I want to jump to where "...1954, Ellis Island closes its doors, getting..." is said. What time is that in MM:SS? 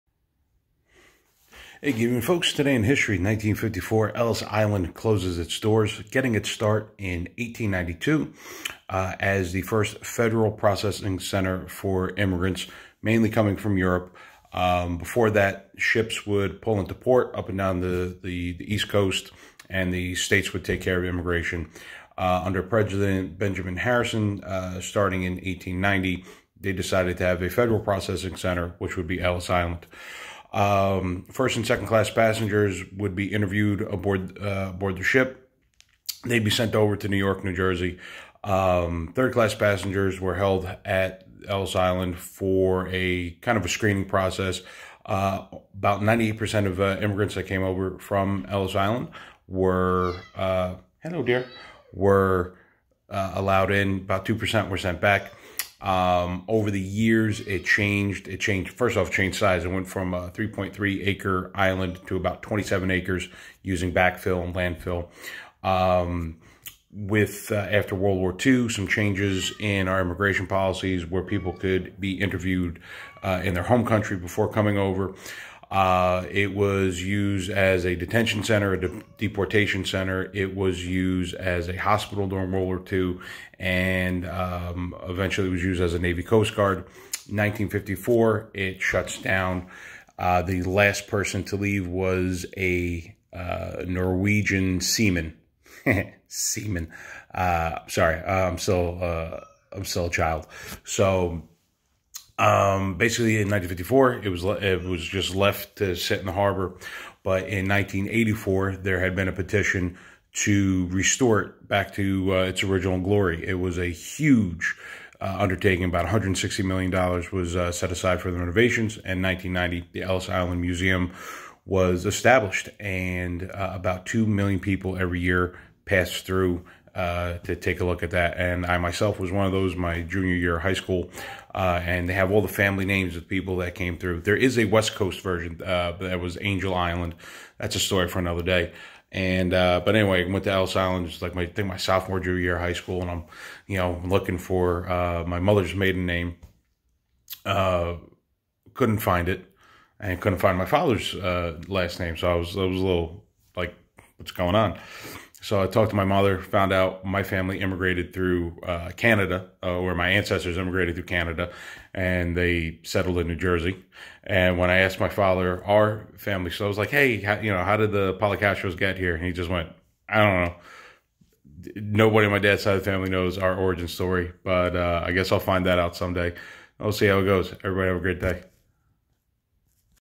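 00:03.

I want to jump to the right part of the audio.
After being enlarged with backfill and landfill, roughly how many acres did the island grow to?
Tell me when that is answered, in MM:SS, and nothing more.
01:02.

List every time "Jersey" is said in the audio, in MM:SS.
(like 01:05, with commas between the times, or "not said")
00:37, 02:43.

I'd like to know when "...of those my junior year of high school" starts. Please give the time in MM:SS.
02:09.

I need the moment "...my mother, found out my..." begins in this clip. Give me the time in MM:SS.
02:35.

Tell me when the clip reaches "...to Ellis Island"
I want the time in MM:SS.
02:20.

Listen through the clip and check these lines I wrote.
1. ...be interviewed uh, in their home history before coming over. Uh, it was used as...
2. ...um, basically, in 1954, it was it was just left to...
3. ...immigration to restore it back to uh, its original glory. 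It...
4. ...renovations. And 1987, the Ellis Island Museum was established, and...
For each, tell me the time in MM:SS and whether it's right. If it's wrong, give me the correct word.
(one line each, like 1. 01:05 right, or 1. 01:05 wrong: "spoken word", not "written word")
1. 01:11 wrong: "country", not "history"
2. 01:42 right
3. 01:49 wrong: "petition", not "immigration"
4. 01:58 wrong: "1990", not "1987".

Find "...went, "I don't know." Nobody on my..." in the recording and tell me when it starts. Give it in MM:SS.
02:49.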